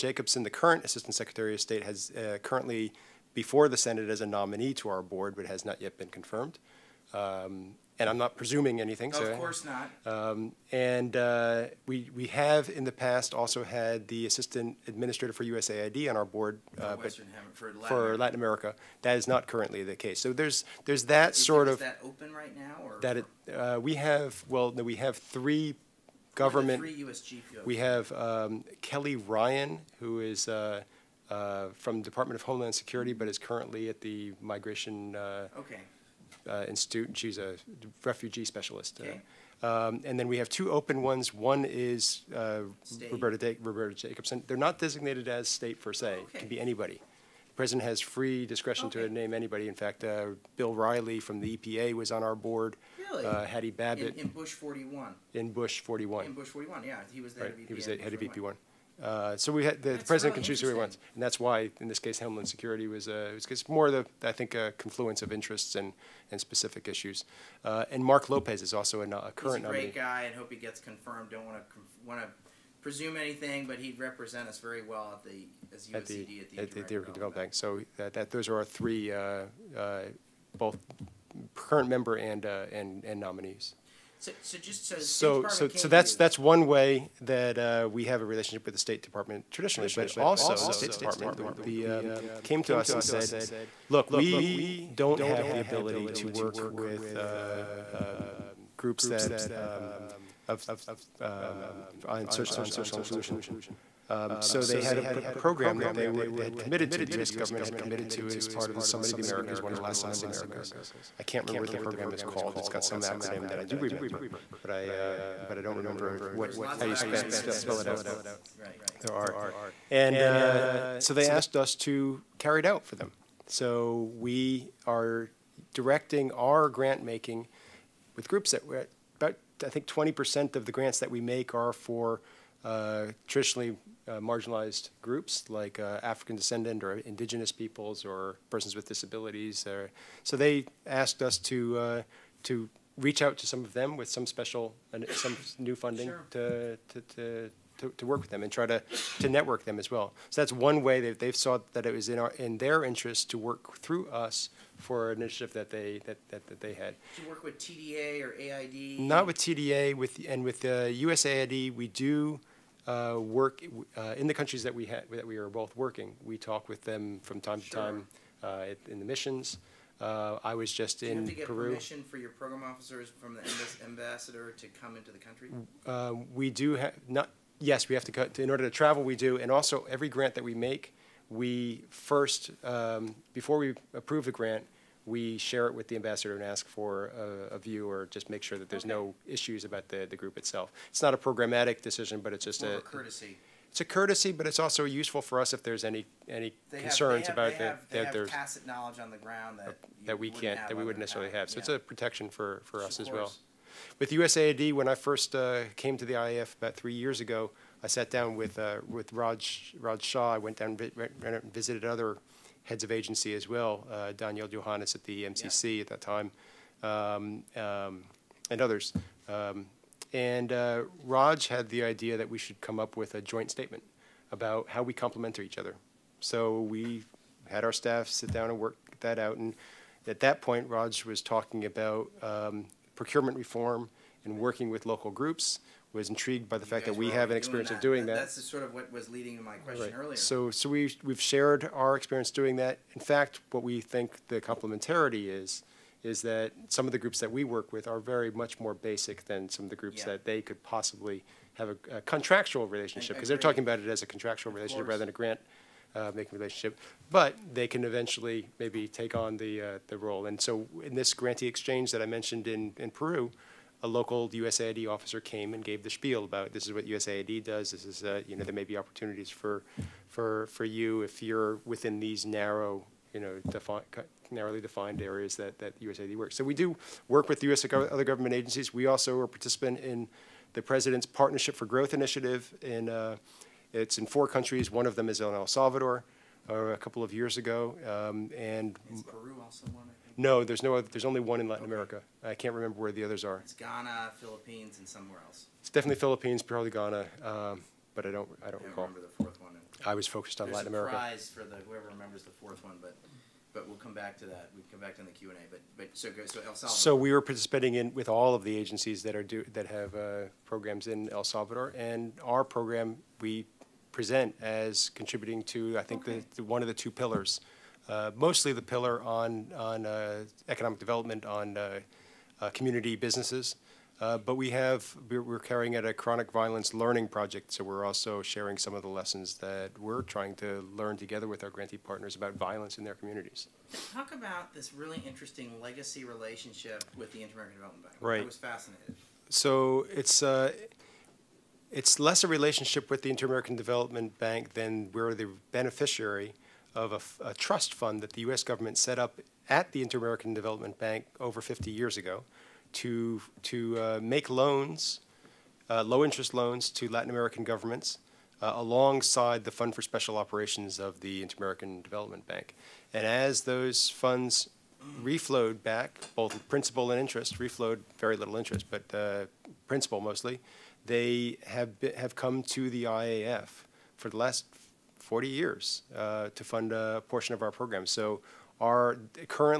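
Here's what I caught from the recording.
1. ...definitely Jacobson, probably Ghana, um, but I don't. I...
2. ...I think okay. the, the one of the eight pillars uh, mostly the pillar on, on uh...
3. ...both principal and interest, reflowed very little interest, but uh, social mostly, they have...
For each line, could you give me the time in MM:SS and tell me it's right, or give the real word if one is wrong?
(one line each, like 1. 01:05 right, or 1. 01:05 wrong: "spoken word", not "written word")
1. 04:55 wrong: "Philippines", not "Jacobson"
2. 05:15 wrong: "two", not "eight"
3. 06:06 wrong: "principal", not "social".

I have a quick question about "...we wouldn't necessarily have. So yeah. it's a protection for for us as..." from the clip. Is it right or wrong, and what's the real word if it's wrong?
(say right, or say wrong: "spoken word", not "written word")
right.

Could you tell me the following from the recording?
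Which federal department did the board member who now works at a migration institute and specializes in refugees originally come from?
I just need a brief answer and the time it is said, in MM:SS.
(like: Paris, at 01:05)
Department of Homeland Security, at 00:32.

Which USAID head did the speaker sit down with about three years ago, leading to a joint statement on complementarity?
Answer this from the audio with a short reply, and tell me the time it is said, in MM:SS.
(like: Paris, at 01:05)
Raj Shah, at 03:29.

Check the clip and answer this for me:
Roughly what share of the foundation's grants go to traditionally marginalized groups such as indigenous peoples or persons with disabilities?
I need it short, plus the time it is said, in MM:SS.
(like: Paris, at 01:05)
20%, at 02:09.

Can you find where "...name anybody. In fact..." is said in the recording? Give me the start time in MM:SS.
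00:49.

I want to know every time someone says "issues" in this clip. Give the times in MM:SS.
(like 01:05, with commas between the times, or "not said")
01:06, 03:09.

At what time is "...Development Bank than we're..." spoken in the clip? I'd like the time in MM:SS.
05:43.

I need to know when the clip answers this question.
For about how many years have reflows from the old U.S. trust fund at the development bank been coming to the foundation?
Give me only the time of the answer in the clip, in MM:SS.
06:15.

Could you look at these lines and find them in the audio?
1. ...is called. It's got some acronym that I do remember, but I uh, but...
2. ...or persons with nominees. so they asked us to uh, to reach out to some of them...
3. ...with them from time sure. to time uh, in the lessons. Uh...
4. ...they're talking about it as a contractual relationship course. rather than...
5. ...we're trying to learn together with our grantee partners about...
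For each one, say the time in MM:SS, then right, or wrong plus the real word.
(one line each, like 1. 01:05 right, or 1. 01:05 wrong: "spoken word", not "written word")
1. 01:52 right
2. 02:18 wrong: "disabilities", not "nominees"
3. 02:46 wrong: "missions", not "lessons"
4. 04:13 right
5. 05:29 right.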